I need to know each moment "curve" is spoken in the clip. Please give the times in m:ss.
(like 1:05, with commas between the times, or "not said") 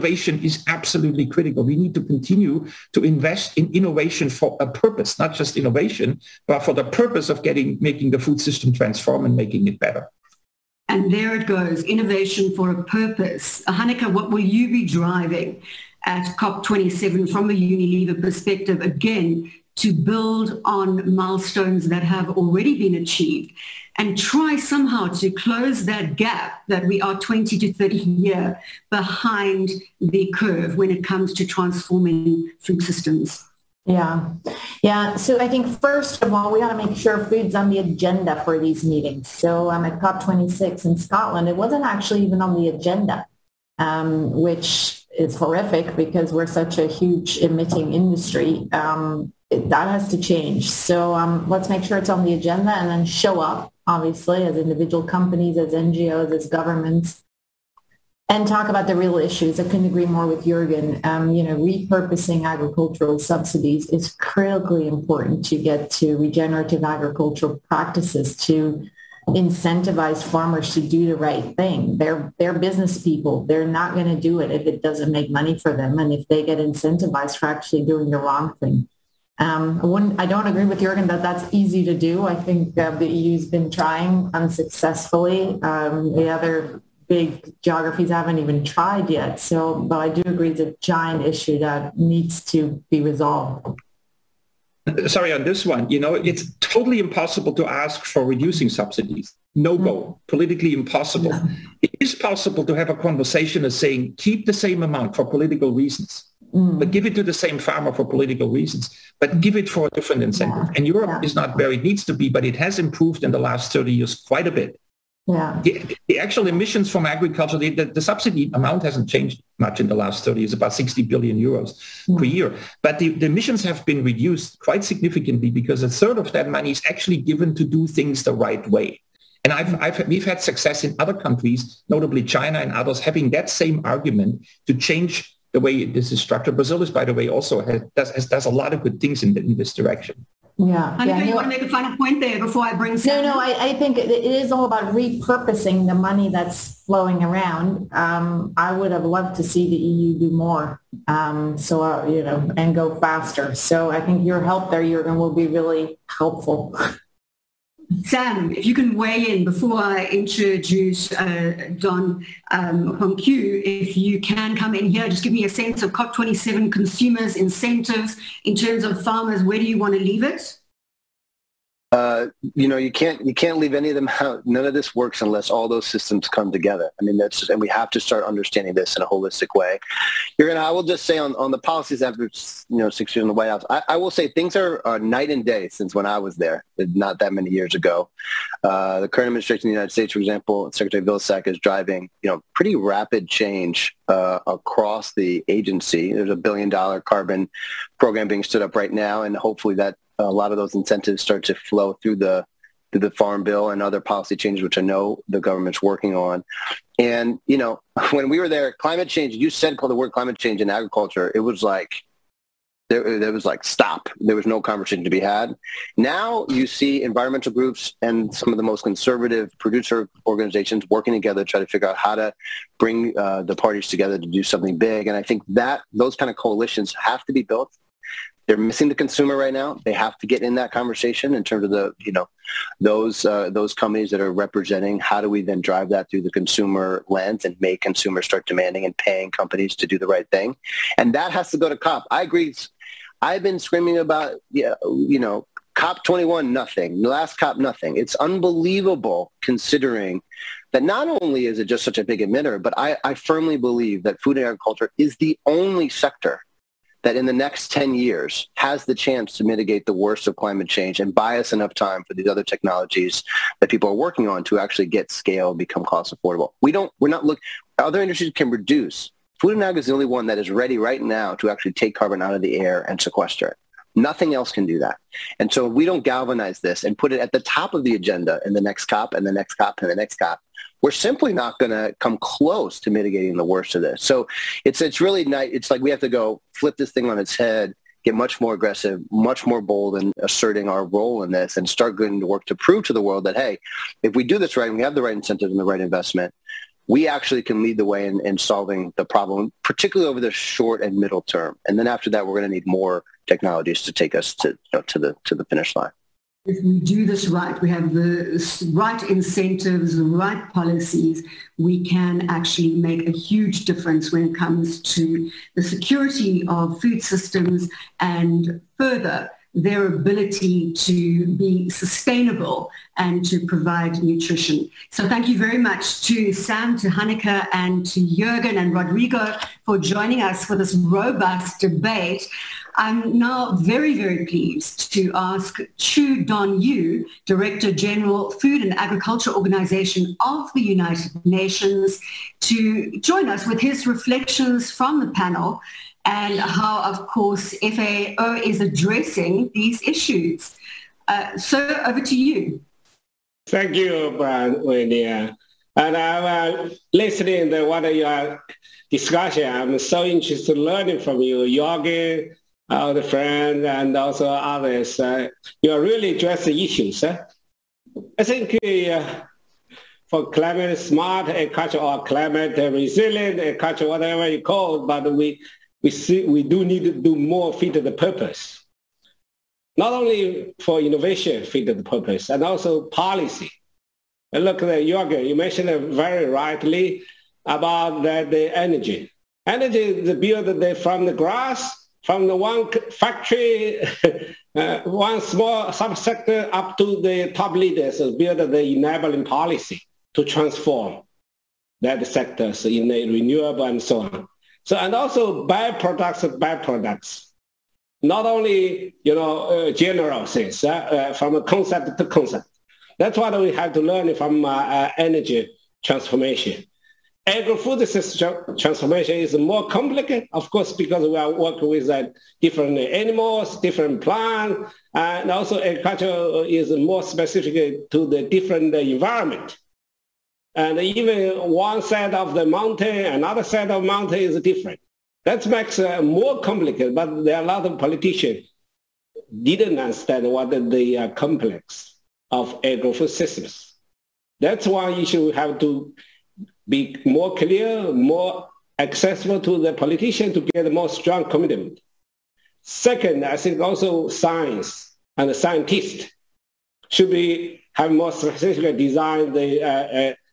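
0:30.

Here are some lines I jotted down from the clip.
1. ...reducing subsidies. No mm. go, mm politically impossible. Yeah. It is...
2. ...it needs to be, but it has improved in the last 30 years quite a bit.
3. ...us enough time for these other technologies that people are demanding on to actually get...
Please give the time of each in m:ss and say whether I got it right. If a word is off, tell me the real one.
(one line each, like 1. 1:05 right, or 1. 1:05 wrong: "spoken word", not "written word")
1. 1:38 right
2. 1:51 right
3. 4:21 wrong: "working", not "demanding".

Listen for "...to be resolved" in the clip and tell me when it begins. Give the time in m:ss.
1:32.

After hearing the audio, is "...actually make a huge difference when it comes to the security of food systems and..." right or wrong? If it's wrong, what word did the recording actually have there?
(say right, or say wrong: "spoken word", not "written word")
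right.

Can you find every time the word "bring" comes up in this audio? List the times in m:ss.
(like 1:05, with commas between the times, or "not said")
2:22, 3:42.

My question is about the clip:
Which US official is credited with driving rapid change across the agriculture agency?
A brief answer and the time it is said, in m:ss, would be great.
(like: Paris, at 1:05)
Secretary Vilsack, at 3:10.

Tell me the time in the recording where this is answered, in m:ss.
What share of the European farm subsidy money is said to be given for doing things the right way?
2:05.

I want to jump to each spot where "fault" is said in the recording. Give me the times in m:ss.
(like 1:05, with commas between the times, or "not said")
not said.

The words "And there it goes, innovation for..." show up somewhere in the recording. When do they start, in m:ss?
0:10.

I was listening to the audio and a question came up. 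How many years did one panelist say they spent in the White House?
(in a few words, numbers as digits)
Six years.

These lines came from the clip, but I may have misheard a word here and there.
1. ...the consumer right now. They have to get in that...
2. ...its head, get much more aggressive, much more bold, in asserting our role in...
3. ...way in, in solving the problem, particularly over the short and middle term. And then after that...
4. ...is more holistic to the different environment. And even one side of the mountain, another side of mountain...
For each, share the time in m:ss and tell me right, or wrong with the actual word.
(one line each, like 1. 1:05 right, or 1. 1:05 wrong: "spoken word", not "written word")
1. 3:48 right
2. 4:47 right
3. 4:57 right
4. 7:06 wrong: "specific", not "holistic".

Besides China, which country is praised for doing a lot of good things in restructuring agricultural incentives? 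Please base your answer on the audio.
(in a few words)
Brazil.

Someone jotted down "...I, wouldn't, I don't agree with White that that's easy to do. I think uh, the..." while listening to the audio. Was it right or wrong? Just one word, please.
wrong.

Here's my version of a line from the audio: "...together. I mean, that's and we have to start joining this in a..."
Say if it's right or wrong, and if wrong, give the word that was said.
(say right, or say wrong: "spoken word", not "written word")
wrong: "understanding", not "joining".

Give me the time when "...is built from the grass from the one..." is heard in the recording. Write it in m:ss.
6:29.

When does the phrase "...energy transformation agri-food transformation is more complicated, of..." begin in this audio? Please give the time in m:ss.
6:54.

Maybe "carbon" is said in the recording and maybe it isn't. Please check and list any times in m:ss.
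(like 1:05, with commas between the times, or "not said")
3:17, 4:31.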